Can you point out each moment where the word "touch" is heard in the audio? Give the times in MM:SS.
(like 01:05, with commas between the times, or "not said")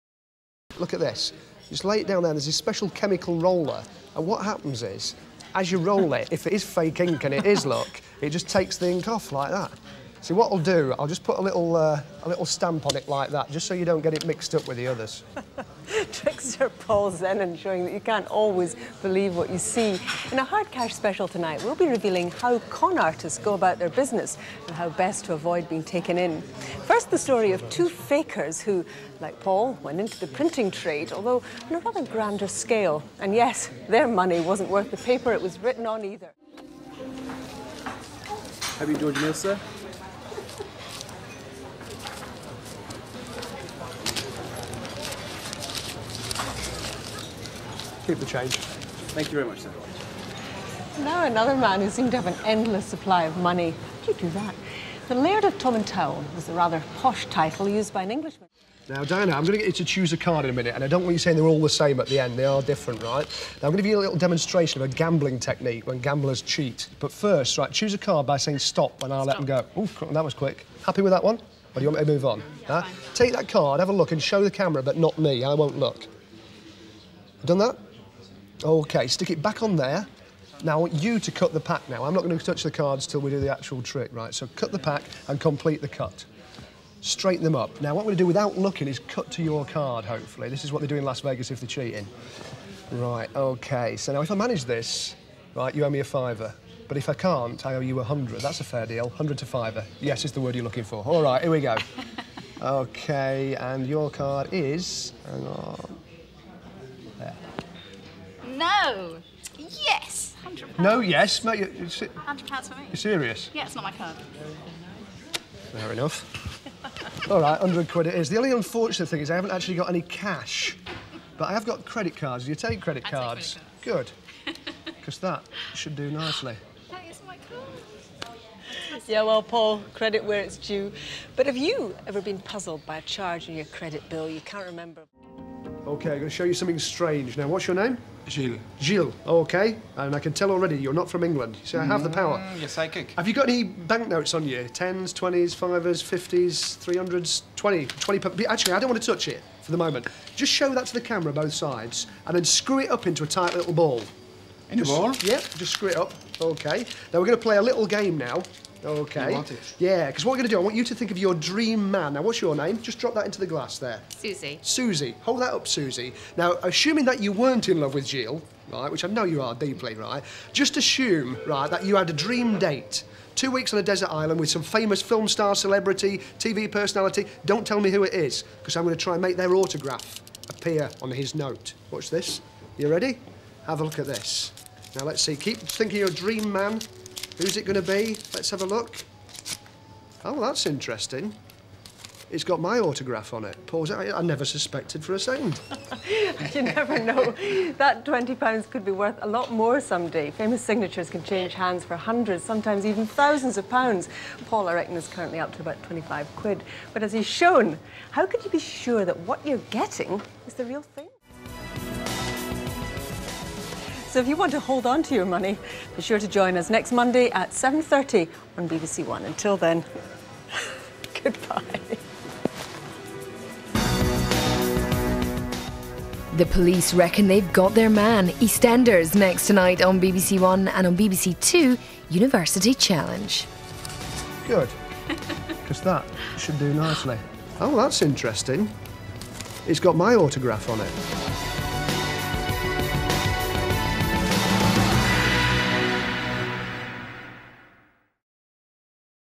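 01:22, 02:29.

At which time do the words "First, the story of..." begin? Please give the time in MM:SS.
00:26.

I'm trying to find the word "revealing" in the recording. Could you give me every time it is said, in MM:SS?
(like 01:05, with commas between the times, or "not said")
00:21.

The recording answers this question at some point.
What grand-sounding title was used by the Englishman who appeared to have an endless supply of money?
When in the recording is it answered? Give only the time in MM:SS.
00:55.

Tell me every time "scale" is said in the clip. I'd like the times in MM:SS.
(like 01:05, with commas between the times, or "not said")
00:32.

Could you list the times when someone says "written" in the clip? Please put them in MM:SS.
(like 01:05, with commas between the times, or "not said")
00:35.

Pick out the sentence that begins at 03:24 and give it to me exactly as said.
Paul, I reckon, is currently up to about 25 quid.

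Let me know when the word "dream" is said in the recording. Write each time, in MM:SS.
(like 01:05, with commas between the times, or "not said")
02:41, 02:52, 03:06.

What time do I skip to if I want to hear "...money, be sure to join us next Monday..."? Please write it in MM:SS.
03:35.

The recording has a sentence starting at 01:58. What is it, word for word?
The only unfortunate thing is I haven't actually got any cash.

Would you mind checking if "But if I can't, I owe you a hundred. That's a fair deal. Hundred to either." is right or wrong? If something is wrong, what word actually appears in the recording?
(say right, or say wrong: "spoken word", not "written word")
wrong: "fiver", not "either".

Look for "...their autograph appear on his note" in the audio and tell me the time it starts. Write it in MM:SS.
02:59.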